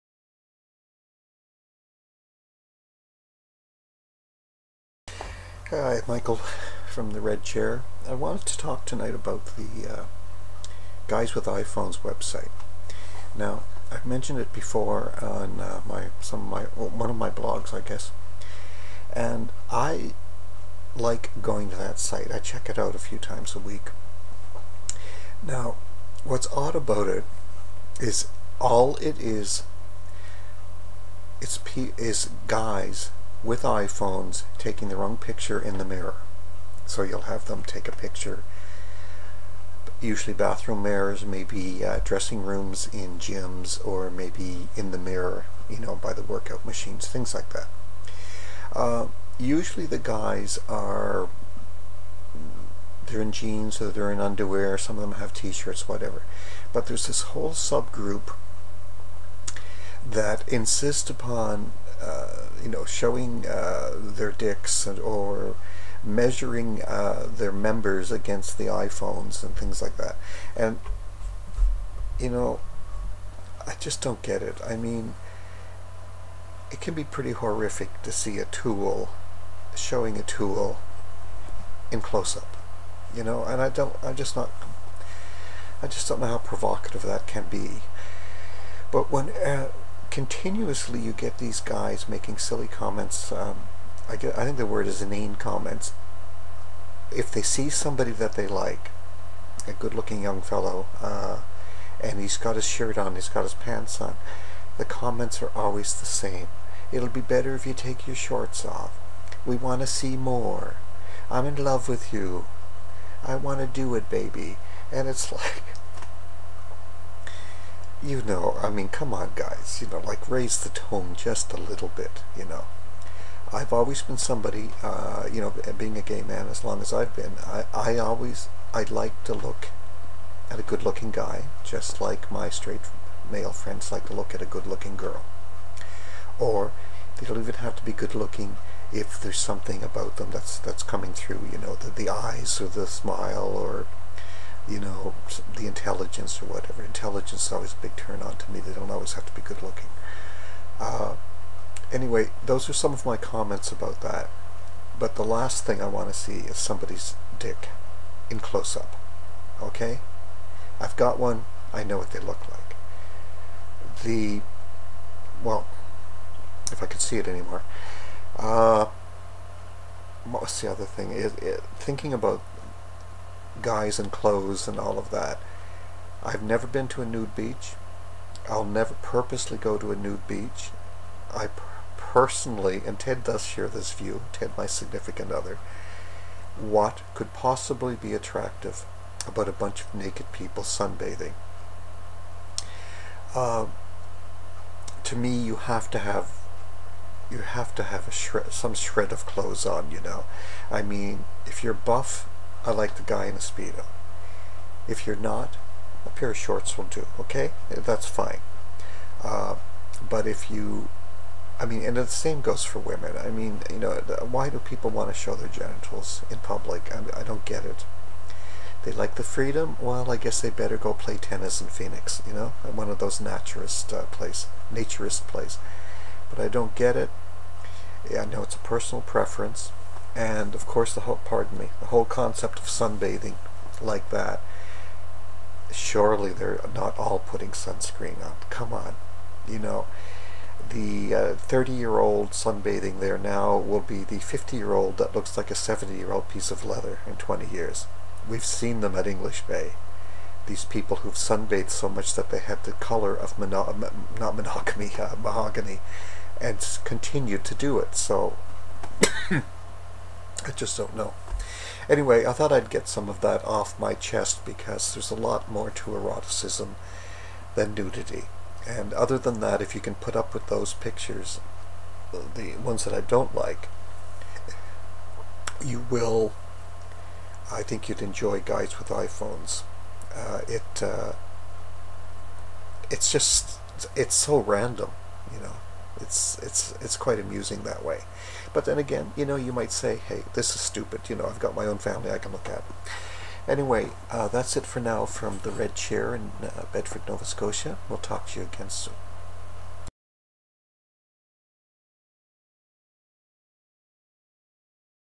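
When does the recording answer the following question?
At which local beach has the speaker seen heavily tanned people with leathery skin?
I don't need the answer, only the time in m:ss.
4:09.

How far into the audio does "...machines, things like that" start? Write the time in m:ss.
0:46.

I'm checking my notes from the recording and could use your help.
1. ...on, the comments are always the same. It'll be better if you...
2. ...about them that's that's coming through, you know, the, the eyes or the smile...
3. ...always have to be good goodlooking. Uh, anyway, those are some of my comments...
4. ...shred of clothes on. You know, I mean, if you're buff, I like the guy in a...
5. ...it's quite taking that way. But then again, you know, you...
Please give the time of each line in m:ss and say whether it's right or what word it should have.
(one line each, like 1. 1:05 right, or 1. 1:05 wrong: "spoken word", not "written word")
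1. 1:44 right
2. 2:19 right
3. 2:28 wrong: "looking", not "goodlooking"
4. 3:18 right
5. 4:46 wrong: "amusing", not "taking".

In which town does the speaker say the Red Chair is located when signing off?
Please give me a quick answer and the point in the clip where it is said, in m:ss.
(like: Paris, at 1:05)
Bedford, Nova Scotia, at 4:56.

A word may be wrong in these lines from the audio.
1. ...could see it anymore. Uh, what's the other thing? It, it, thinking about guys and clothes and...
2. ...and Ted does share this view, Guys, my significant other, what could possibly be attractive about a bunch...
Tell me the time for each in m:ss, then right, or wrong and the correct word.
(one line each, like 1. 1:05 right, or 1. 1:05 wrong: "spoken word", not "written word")
1. 2:46 right
2. 3:02 wrong: "Ted", not "Guys".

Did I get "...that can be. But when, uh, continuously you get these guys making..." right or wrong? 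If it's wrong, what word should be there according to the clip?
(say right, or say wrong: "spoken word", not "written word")
right.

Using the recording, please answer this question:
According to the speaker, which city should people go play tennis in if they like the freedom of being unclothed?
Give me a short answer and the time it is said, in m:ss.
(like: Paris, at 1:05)
Phoenix, at 3:41.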